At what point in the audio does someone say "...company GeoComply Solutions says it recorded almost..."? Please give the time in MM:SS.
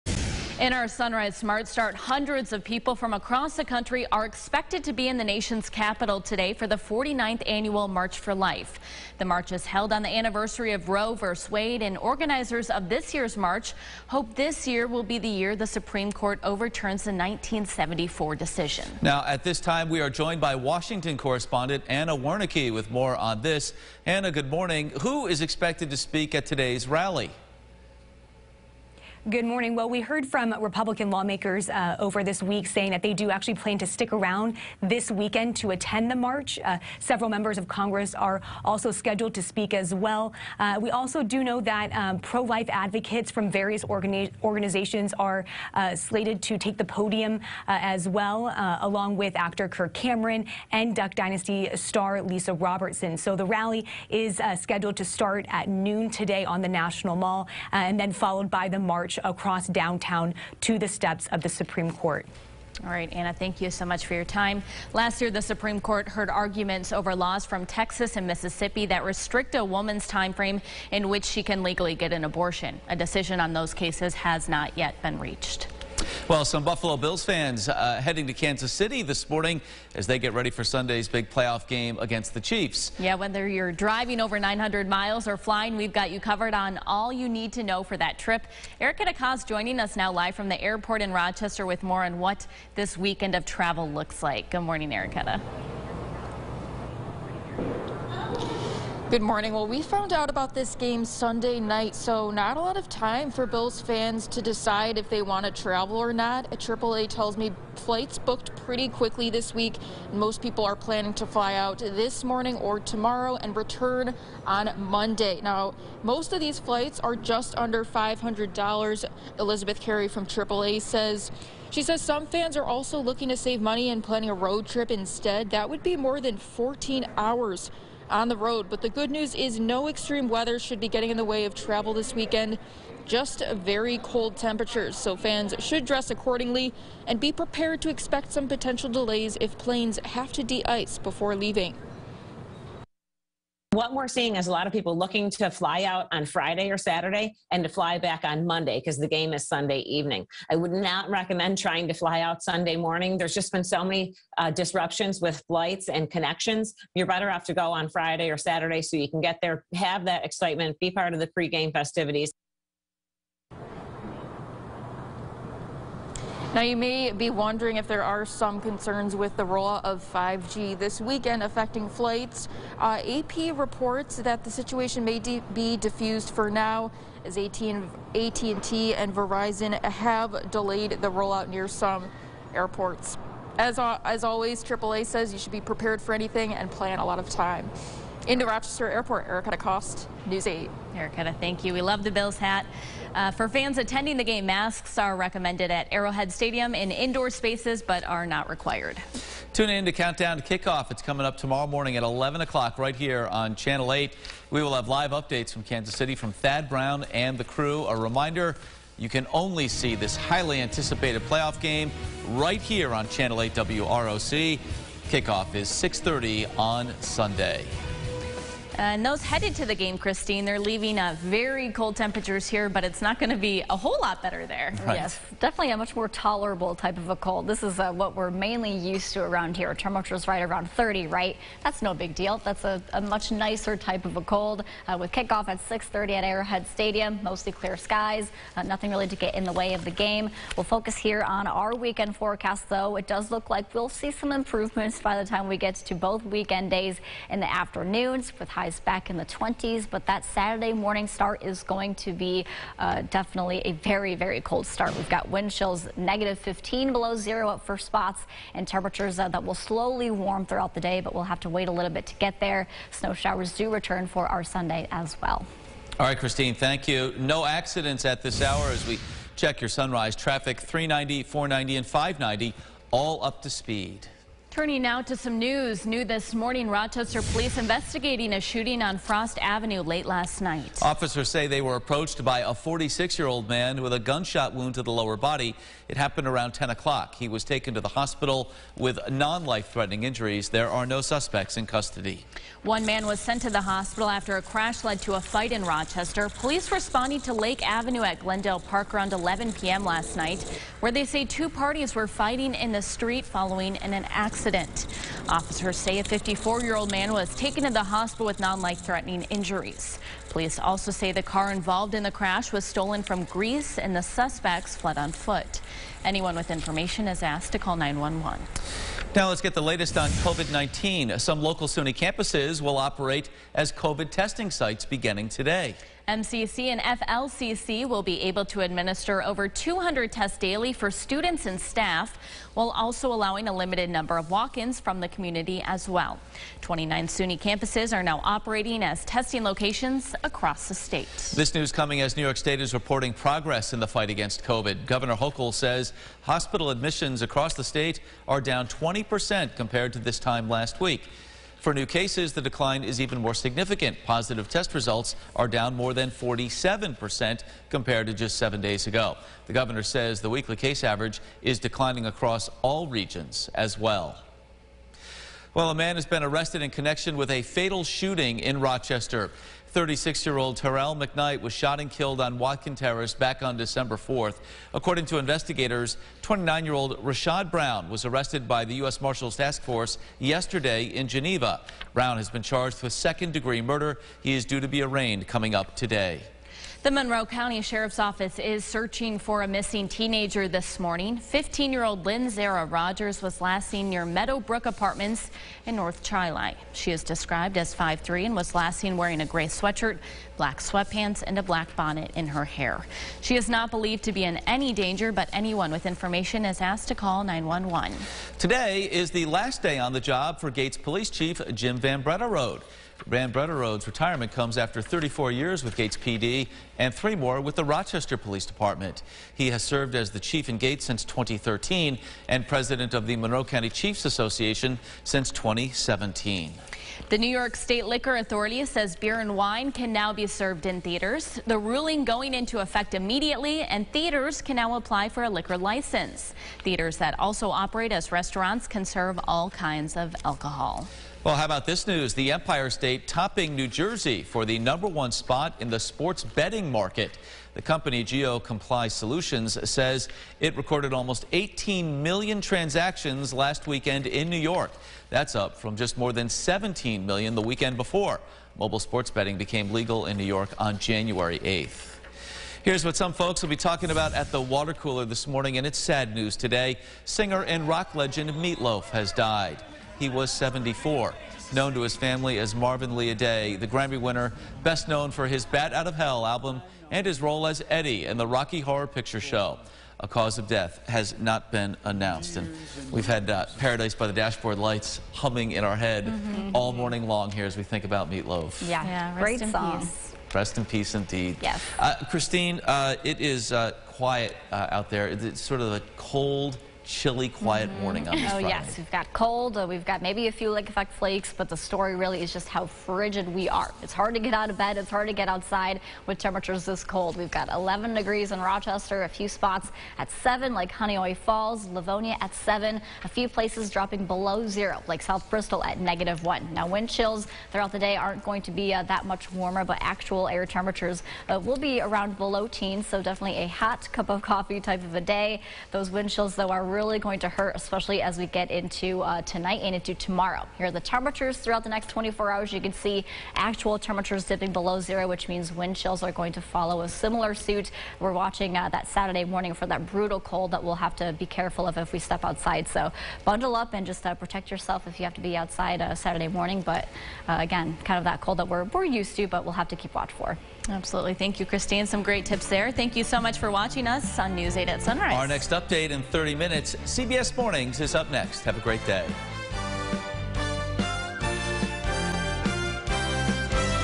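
07:27.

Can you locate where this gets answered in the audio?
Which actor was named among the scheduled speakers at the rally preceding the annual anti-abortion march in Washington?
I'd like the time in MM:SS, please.
00:49.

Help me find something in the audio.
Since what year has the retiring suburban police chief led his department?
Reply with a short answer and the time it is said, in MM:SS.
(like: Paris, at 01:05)
2013, at 07:01.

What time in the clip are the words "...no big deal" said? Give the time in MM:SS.
03:51.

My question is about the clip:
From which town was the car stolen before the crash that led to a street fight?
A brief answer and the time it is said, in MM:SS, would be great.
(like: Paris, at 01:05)
Greece, at 05:13.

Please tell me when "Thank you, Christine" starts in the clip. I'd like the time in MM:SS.
09:11.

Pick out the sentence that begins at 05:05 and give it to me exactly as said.
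Officers say a 54-year-old man was taken to the hospital with non-life-threatening injuries.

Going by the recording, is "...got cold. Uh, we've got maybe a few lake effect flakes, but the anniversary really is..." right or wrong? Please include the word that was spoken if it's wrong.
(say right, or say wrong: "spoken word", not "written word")
wrong: "story", not "anniversary".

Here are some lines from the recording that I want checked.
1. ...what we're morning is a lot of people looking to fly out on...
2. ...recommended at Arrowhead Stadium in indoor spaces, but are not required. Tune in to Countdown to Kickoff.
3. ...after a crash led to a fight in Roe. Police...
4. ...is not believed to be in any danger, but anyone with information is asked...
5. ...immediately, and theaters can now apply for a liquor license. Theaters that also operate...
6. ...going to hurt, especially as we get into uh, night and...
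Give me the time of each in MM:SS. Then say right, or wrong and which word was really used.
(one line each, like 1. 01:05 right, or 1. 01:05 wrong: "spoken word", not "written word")
1. 02:23 wrong: "seeing", not "morning"
2. 03:15 right
3. 04:54 wrong: "Rochester", not "Roe"
4. 06:43 right
5. 07:12 right
6. 08:46 wrong: "tonight", not "night".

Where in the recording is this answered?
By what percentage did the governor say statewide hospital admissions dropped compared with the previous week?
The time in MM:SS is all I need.
05:48.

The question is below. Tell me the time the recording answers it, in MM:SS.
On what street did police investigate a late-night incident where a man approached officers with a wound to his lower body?
04:38.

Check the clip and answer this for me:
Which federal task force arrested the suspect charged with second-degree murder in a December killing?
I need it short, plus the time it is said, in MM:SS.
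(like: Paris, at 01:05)
U.S. Marshals Task Force, at 06:18.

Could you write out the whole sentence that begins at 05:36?
29 SUNY campuses are now operating as testing locations across the state.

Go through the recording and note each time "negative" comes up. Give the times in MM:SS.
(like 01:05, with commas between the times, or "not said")
04:15, 08:35.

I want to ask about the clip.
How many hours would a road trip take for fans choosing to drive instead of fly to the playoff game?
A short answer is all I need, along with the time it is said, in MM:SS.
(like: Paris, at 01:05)
14, at 02:06.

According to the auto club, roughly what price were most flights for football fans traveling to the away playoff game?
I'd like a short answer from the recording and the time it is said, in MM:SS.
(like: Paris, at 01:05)
under $500, at 01:57.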